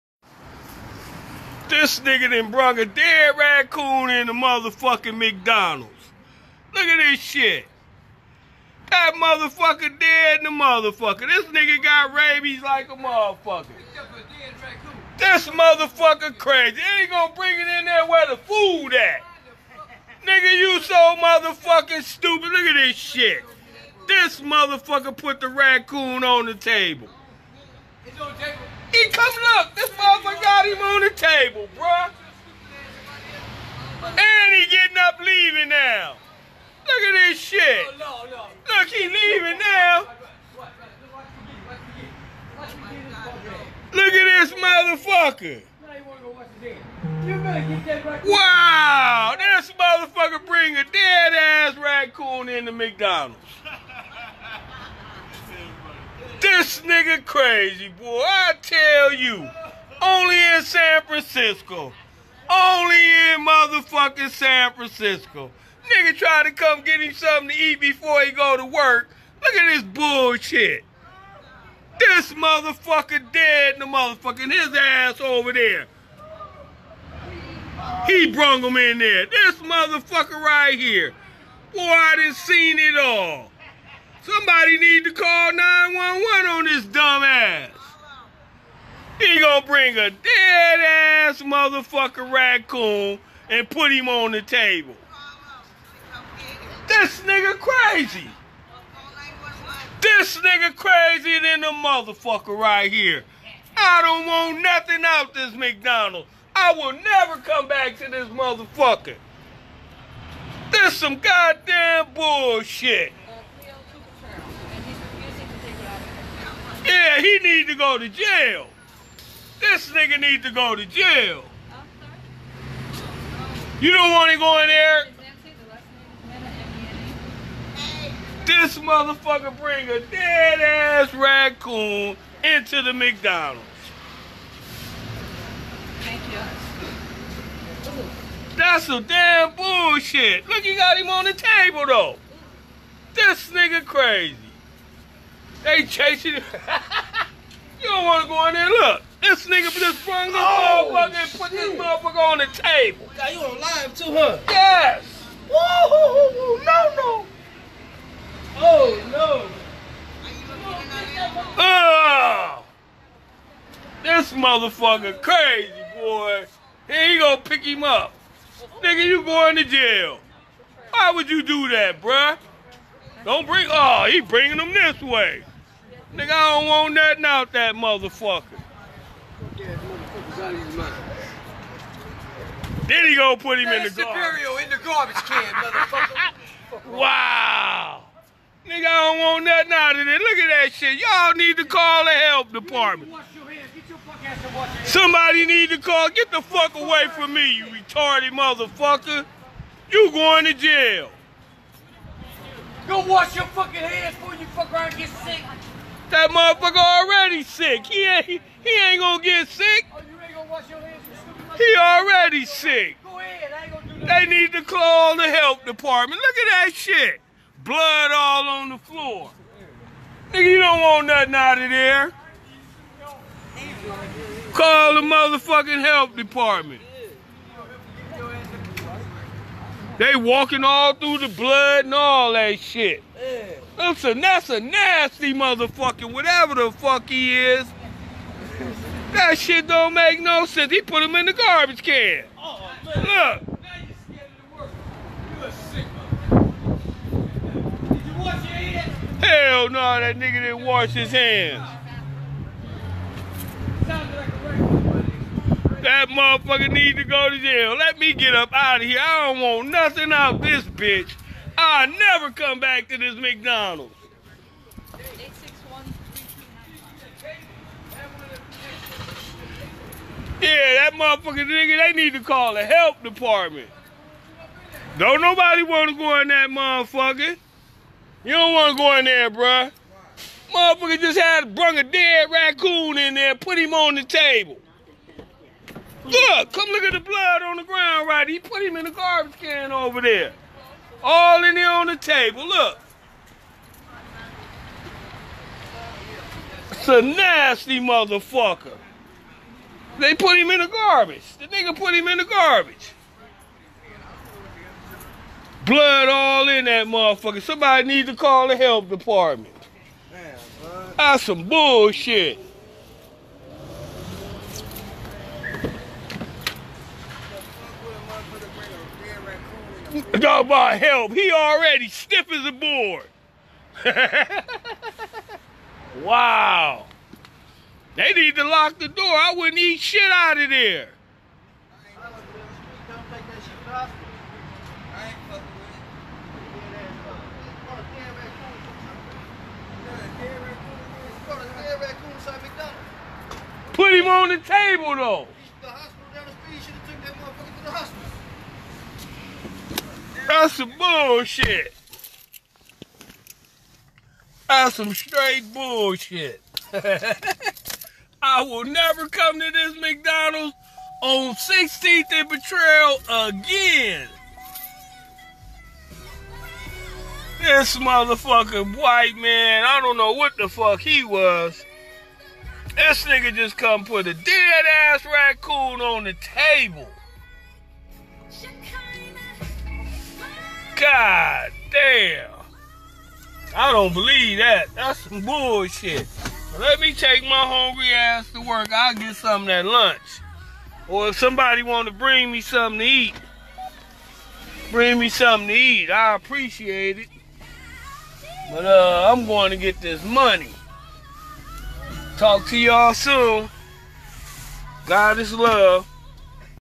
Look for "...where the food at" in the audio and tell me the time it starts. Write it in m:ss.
0:18.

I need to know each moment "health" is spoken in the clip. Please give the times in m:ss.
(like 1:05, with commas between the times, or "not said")
3:35, 3:45, 5:08.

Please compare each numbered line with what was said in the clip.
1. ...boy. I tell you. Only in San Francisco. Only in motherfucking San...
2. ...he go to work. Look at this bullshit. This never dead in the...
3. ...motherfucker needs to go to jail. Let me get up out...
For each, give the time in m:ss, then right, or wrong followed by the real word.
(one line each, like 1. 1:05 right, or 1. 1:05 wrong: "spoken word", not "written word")
1. 0:57 right
2. 1:08 wrong: "motherfucker", not "never"
3. 4:16 right.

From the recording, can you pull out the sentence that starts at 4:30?
Yeah, that motherfucker nigga, they need to call the help department.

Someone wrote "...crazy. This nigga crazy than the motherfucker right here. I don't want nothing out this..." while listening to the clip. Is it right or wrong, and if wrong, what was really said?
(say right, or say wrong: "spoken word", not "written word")
right.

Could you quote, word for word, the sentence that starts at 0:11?
This nigga got rabies like a motherfucker.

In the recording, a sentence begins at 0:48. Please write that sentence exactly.
Wow, this motherfucker bring a dead ass raccoon into McDonald's.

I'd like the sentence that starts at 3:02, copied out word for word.
Then he gonna put him in the, in the garbage.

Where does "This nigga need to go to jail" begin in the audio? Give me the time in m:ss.
1:59.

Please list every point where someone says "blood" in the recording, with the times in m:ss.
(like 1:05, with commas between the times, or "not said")
3:37, 3:51, 4:46, 5:05.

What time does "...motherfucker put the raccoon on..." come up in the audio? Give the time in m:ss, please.
0:24.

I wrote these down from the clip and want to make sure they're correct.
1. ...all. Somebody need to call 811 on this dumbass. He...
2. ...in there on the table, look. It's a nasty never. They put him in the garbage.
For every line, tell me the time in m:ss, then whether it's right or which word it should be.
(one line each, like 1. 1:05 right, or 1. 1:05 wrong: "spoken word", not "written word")
1. 1:22 wrong: "911", not "811"
2. 4:51 wrong: "motherfucker", not "never".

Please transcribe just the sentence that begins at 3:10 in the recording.
Y'all need to call the help department.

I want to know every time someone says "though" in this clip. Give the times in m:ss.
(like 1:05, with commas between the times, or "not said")
2:21, 5:44.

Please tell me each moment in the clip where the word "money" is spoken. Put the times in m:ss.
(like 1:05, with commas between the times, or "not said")
6:40.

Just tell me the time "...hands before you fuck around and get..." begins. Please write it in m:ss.
3:23.